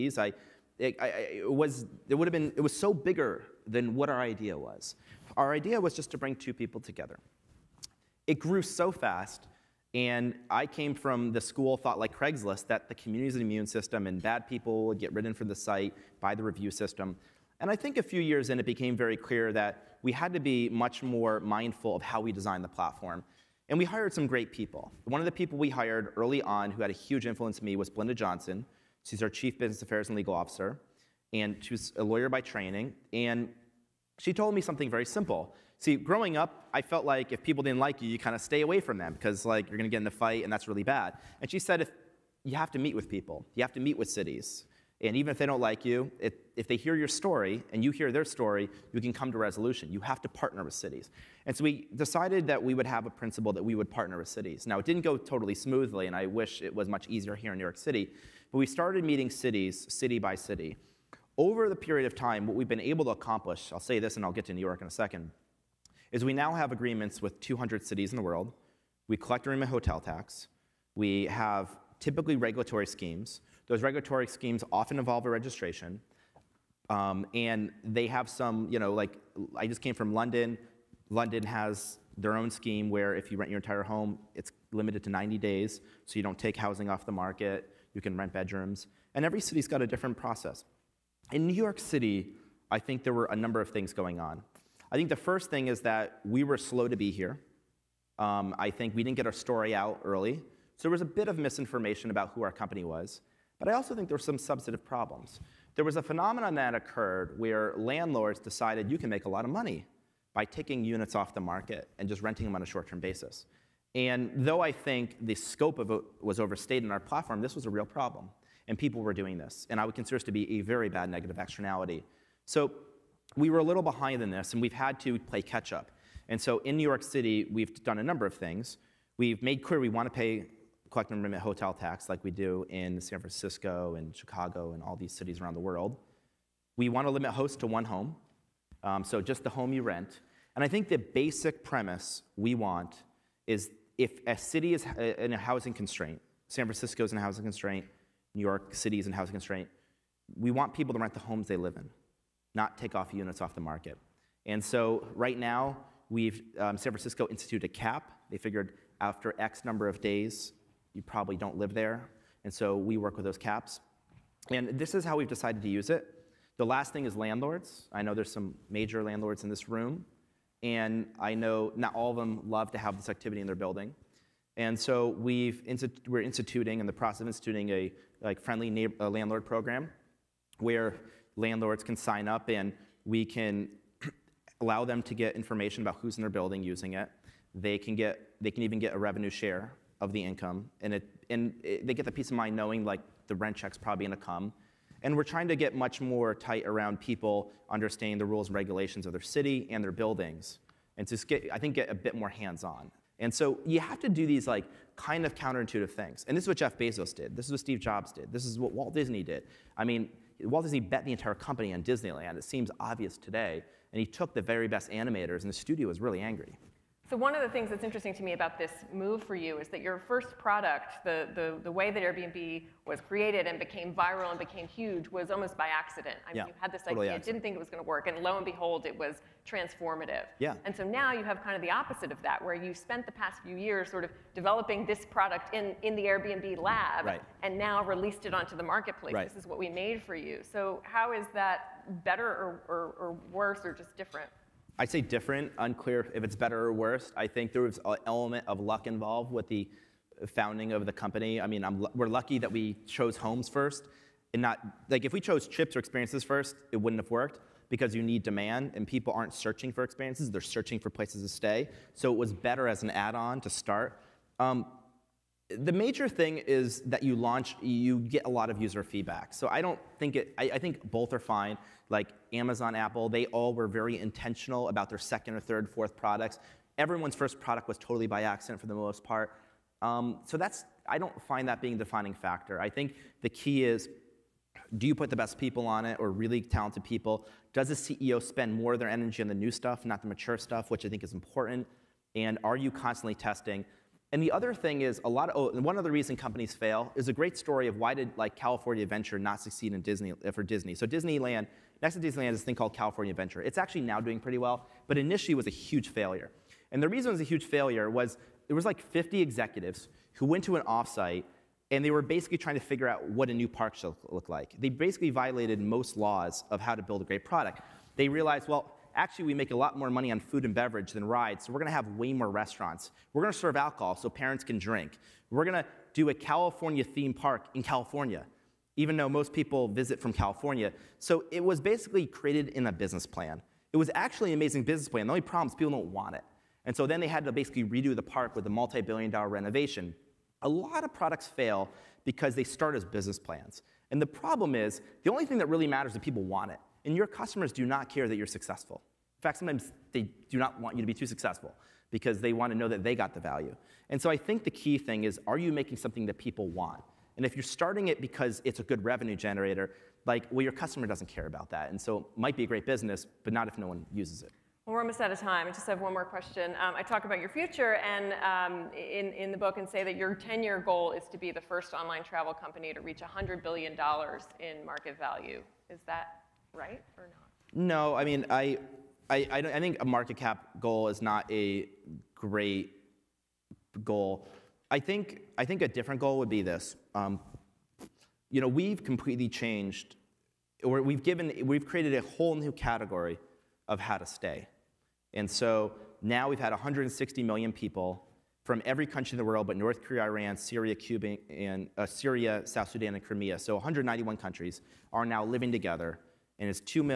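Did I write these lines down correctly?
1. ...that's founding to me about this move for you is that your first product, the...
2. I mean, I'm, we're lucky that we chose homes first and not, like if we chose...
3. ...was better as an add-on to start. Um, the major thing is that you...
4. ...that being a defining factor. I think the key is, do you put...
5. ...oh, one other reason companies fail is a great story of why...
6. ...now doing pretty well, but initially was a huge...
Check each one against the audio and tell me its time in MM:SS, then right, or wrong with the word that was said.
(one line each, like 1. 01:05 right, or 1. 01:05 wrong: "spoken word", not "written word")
1. 03:37 wrong: "interesting", not "founding"
2. 04:11 right
3. 04:22 right
4. 04:41 right
5. 04:55 right
6. 05:03 right.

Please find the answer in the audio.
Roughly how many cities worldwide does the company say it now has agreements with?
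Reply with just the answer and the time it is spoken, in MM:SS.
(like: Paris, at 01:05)
200, at 01:07.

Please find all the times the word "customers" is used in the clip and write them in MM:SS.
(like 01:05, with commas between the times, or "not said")
05:47, 06:00.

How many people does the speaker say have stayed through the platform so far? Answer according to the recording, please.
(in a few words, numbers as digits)
160 million.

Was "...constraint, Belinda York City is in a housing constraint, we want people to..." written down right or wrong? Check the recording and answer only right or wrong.
wrong.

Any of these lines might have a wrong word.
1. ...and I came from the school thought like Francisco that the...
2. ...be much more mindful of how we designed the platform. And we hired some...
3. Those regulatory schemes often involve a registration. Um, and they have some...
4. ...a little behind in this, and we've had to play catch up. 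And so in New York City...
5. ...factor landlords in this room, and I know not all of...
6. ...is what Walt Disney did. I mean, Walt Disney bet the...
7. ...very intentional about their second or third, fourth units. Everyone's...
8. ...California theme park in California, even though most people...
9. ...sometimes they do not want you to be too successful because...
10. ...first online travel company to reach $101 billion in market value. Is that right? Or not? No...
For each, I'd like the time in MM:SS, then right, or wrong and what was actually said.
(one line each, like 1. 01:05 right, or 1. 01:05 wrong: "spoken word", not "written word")
1. 00:09 wrong: "Craigslist", not "Francisco"
2. 00:20 right
3. 01:13 right
4. 02:03 right
5. 02:48 wrong: "major", not "factor"
6. 03:28 right
7. 04:33 wrong: "products", not "units"
8. 05:26 right
9. 05:49 right
10. 06:11 wrong: "100", not "101".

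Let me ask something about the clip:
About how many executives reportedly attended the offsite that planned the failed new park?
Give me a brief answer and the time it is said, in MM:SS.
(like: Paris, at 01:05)
50, at 05:08.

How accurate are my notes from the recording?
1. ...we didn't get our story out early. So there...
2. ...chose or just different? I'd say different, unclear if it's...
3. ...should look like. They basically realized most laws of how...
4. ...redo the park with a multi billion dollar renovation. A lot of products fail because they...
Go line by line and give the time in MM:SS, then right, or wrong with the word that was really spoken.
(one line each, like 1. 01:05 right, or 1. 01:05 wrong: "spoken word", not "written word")
1. 01:38 right
2. 04:03 wrong: "worse", not "chose"
3. 05:13 wrong: "violated", not "realized"
4. 05:37 right.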